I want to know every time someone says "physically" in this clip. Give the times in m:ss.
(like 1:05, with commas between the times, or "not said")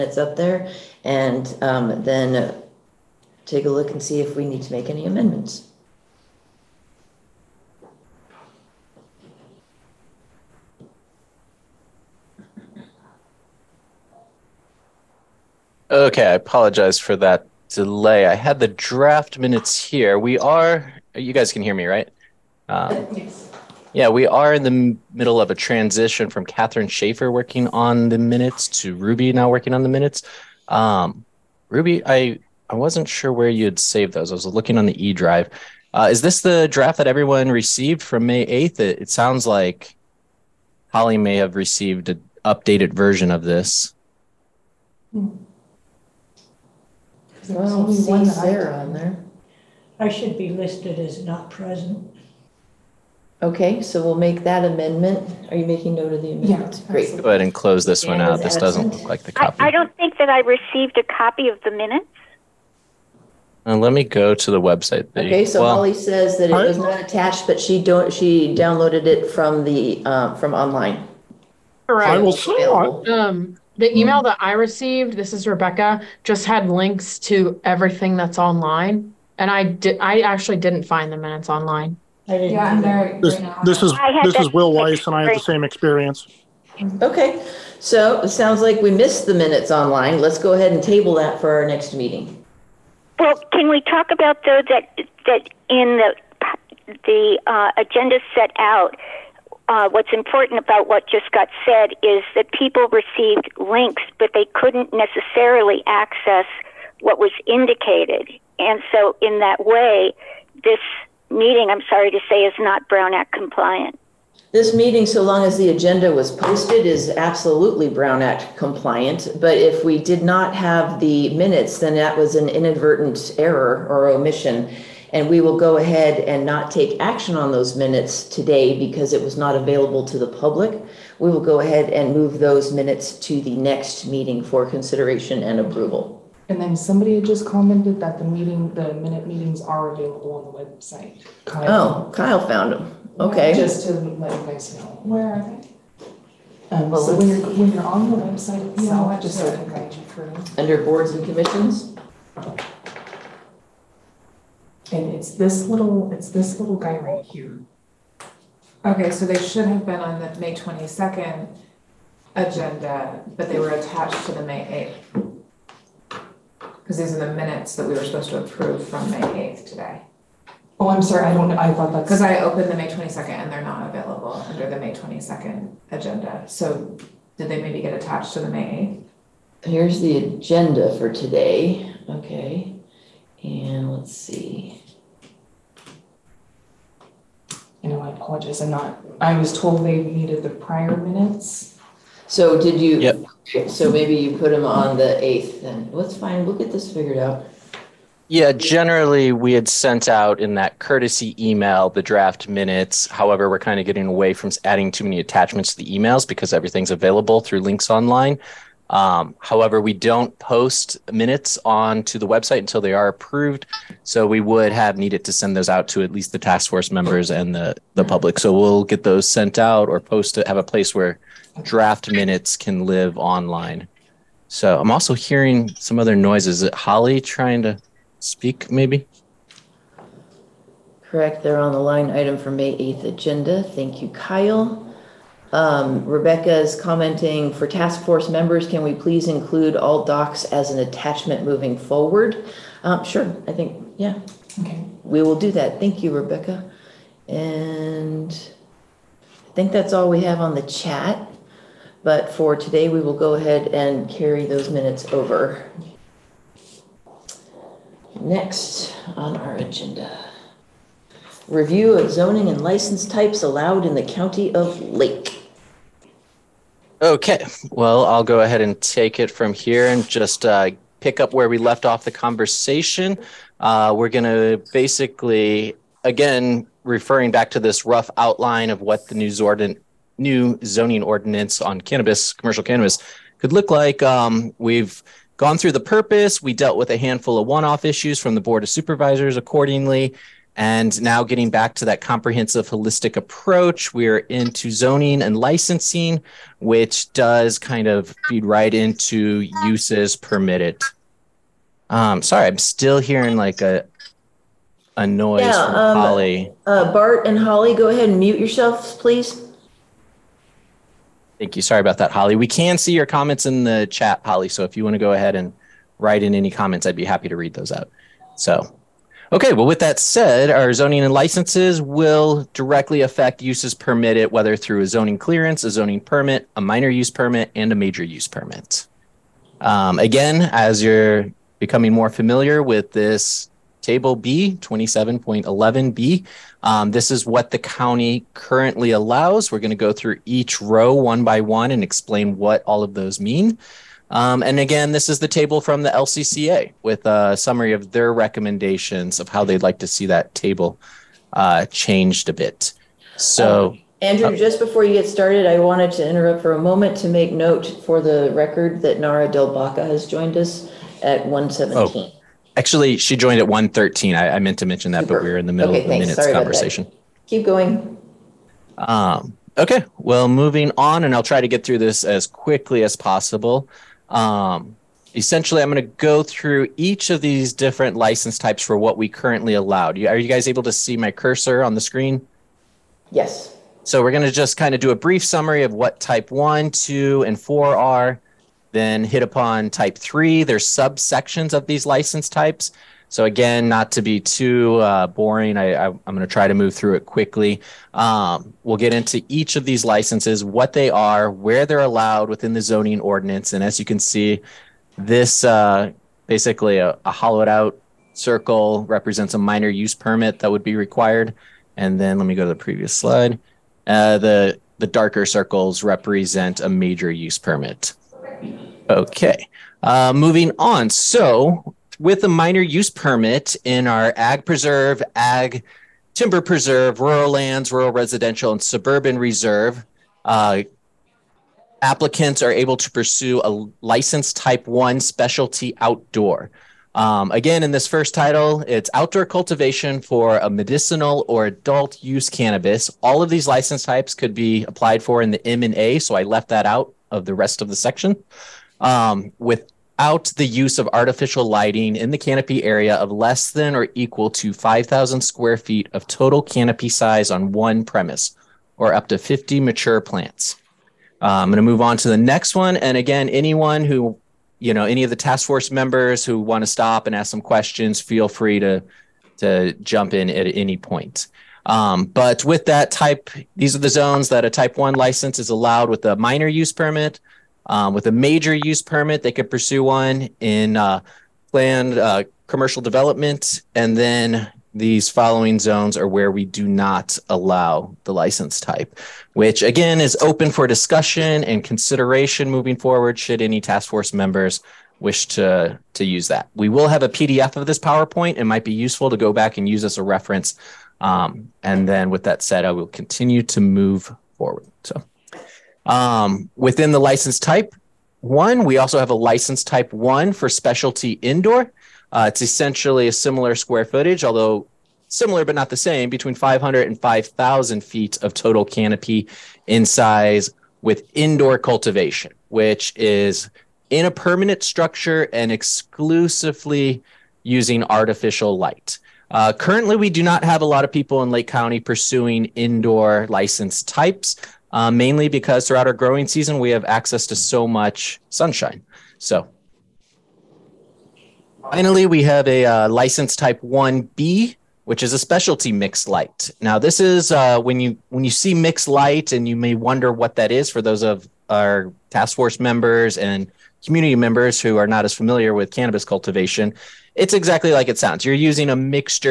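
not said.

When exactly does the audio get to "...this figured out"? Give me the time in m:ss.
3:16.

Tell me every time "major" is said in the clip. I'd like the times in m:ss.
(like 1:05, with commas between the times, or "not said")
5:27, 6:56, 7:58.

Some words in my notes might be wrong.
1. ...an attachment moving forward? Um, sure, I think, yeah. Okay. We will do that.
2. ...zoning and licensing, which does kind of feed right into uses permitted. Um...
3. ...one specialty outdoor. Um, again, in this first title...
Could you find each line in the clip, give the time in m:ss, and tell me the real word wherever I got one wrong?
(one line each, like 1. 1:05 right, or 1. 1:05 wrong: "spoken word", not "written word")
1. 4:00 right
2. 4:54 right
3. 7:14 right.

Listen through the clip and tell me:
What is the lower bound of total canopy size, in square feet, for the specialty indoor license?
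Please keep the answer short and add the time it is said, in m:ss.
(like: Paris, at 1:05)
500, at 8:36.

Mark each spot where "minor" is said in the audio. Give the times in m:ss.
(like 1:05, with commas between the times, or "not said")
5:26, 6:49, 7:02, 7:56.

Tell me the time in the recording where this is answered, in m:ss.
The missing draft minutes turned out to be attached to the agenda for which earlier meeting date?
3:52.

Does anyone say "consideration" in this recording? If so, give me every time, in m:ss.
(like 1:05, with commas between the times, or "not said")
2:14, 8:11.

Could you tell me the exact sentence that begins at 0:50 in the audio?
I should be listed as not present.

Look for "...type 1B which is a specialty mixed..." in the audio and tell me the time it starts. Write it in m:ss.
9:03.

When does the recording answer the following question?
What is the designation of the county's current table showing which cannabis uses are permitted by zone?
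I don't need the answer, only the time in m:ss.
5:34.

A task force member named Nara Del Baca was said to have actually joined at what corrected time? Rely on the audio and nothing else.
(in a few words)
113.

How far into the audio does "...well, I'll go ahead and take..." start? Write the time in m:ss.
4:27.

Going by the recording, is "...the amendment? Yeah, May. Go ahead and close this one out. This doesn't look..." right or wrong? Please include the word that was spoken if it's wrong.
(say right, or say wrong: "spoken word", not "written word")
wrong: "Great", not "May".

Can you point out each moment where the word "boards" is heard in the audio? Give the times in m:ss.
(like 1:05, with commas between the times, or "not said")
2:30, 4:48.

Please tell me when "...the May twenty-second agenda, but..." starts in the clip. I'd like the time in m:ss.
2:40.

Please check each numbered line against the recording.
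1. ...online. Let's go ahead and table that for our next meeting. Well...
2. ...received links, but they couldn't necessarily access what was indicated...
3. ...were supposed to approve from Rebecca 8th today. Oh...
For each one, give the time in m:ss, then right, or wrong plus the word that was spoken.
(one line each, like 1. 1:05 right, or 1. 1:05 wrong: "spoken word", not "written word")
1. 1:29 right
2. 1:42 right
3. 2:47 wrong: "May", not "Rebecca".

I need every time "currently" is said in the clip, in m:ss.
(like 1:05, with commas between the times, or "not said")
5:38, 6:19, 8:49.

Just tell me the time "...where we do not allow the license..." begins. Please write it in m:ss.
8:06.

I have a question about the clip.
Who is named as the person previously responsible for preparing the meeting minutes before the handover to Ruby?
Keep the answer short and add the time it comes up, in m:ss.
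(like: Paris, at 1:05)
Catherine Schaefer, at 0:26.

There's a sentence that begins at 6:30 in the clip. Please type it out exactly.
There's subsections of these license types.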